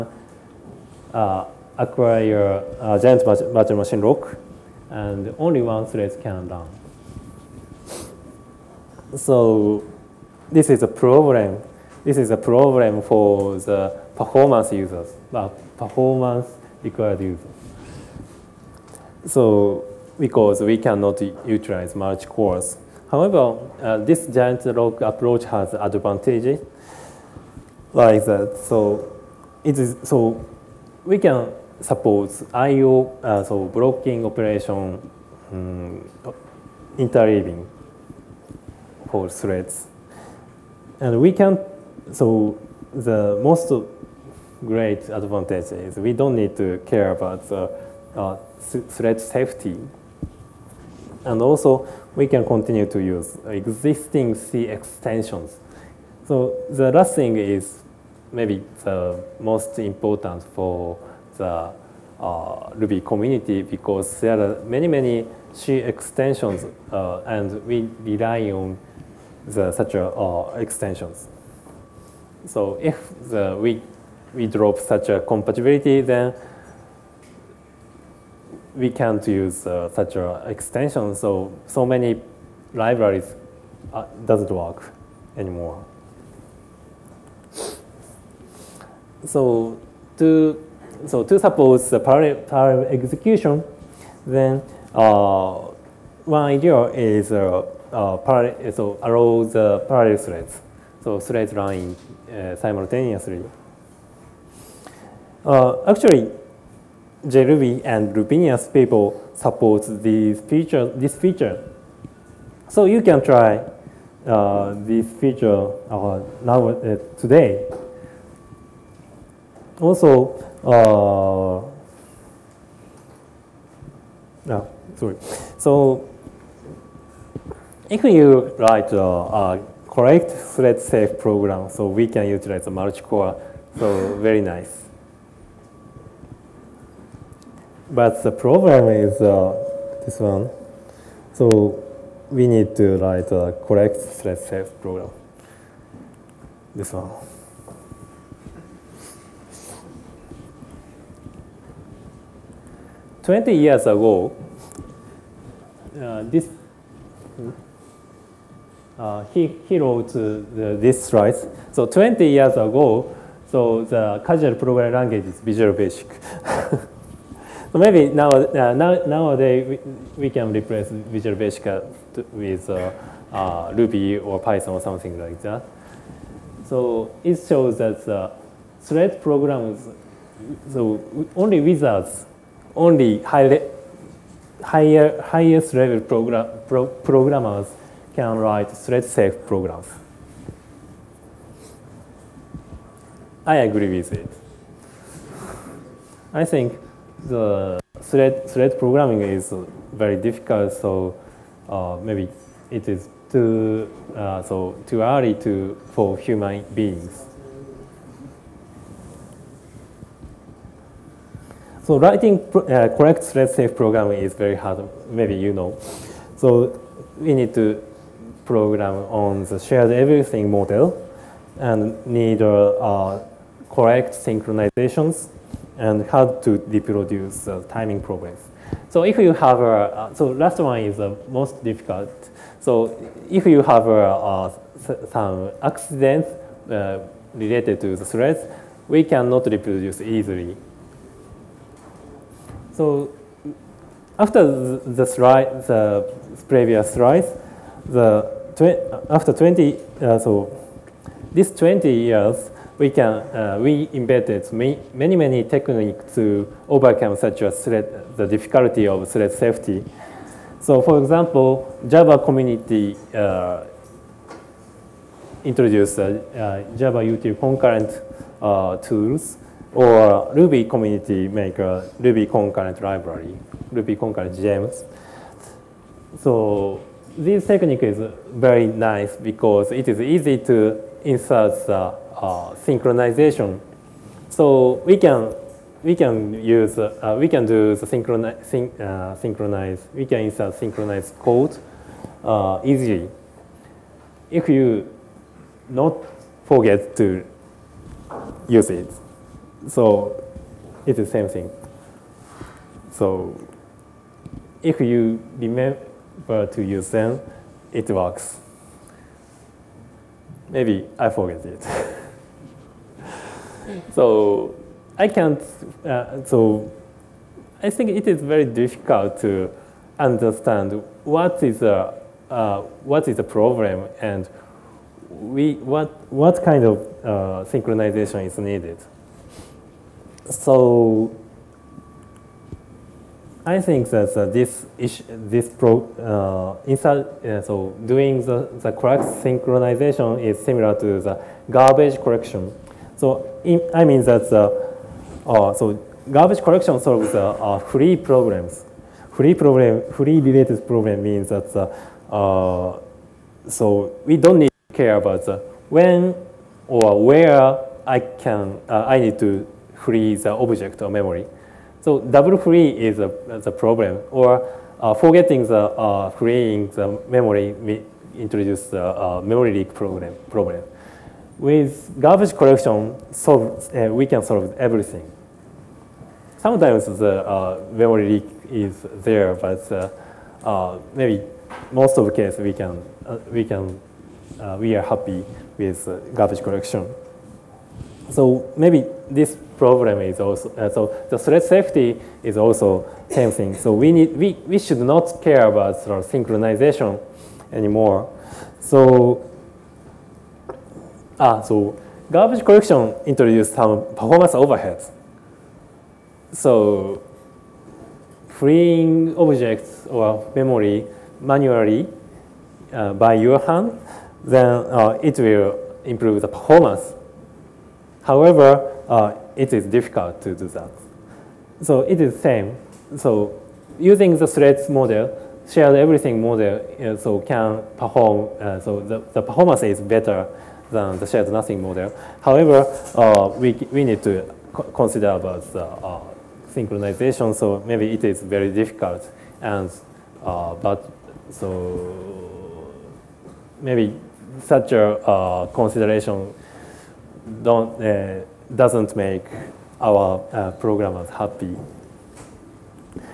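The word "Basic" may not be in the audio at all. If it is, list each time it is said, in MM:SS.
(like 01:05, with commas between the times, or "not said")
02:45, 02:51.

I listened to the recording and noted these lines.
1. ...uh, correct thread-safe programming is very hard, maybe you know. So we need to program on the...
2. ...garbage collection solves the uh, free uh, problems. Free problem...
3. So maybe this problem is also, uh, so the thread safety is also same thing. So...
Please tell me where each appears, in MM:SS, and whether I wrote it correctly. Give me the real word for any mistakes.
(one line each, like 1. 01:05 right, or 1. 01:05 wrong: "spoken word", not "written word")
1. 03:32 right
2. 05:46 right
3. 06:28 right.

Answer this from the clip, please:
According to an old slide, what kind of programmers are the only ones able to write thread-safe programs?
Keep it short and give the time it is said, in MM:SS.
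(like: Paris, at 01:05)
wizards, at 03:01.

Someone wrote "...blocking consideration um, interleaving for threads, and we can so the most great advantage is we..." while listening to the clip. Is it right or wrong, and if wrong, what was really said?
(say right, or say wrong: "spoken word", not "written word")
wrong: "operation", not "consideration".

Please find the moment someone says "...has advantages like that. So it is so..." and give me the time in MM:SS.
00:25.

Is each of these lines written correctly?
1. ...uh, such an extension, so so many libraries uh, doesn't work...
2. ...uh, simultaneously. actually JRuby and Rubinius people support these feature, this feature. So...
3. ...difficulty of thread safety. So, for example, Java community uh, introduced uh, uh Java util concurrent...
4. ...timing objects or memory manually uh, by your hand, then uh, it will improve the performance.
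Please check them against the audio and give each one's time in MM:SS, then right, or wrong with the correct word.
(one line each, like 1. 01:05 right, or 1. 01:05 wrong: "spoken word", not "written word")
1. 01:19 right
2. 01:42 right
3. 04:18 right
4. 06:48 wrong: "freeing", not "timing".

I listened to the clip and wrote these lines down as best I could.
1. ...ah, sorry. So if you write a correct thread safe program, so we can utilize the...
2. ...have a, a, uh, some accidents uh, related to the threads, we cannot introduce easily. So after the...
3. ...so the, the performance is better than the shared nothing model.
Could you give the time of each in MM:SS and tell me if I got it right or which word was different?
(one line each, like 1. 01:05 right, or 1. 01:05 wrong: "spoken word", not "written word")
1. 02:04 right
2. 03:53 wrong: "reproduce", not "introduce"
3. 07:08 right.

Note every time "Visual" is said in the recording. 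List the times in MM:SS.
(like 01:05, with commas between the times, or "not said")
02:45, 02:50.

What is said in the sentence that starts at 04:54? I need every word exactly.
If you not forget to use it, so it's the same thing.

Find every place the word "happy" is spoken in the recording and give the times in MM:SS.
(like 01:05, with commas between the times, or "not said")
06:24, 07:31.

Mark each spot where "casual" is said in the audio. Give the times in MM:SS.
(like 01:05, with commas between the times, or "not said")
02:44.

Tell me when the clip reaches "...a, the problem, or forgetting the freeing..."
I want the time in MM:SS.
06:02.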